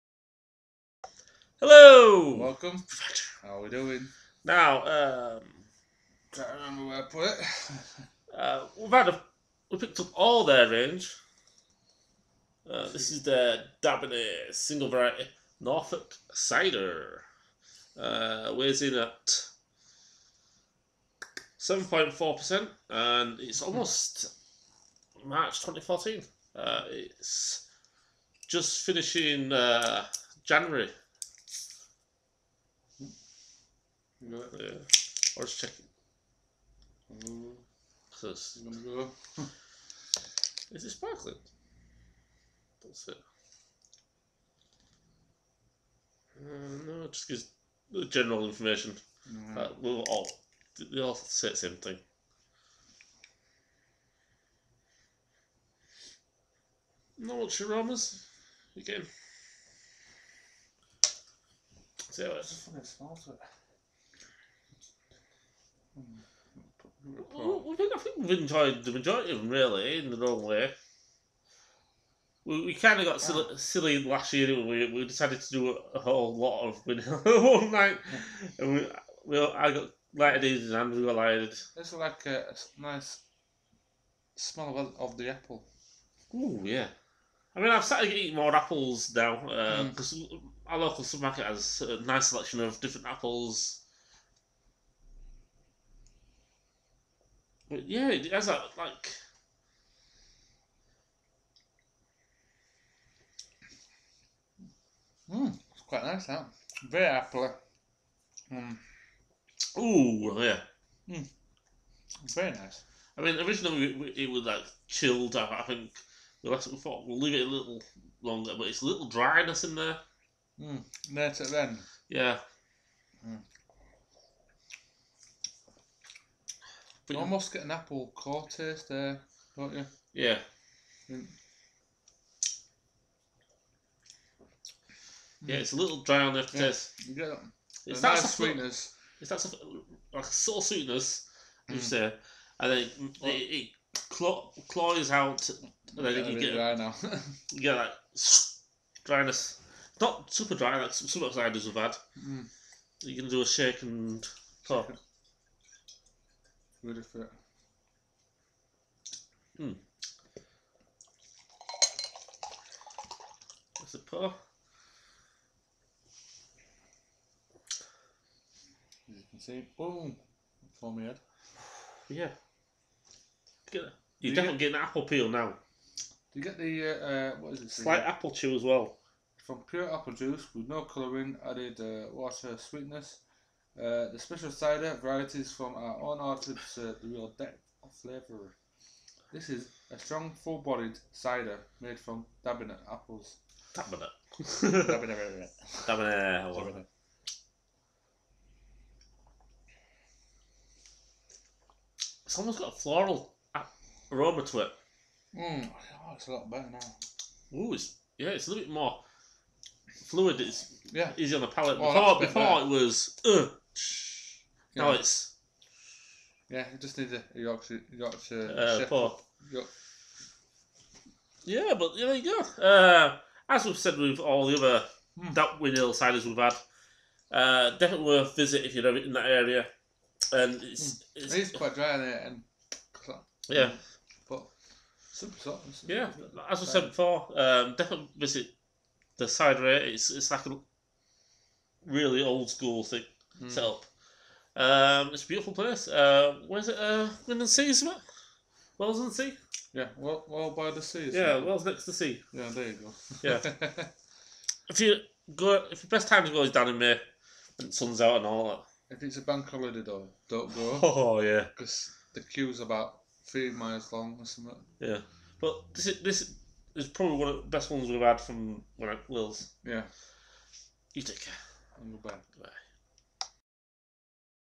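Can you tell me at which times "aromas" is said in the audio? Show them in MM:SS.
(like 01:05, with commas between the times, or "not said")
00:57, 03:24.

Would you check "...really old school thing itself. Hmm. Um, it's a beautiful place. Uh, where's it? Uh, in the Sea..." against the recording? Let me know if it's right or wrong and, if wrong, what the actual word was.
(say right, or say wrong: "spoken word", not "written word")
right.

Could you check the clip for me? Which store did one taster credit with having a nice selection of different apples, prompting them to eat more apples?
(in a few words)
local supermarket.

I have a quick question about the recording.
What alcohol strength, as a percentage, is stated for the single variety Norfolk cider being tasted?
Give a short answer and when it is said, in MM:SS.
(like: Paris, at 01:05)
7.4%, at 00:21.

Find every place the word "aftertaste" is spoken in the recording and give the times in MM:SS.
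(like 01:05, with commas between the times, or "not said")
02:16.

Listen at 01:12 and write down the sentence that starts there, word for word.
We, we kind of got silly, yeah.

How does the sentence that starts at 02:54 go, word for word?
You're you definitely get, getting apple peel now.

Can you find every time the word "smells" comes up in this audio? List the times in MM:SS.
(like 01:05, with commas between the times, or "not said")
01:02, 01:24.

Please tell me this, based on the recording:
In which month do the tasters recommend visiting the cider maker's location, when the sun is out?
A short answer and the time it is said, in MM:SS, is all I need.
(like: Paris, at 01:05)
May, at 04:16.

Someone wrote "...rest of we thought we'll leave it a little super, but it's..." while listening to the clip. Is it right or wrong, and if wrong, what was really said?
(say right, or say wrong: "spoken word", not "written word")
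wrong: "longer", not "super".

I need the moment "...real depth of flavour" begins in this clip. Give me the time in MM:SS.
03:07.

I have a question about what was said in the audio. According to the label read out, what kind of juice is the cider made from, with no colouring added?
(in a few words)
pure apple juice.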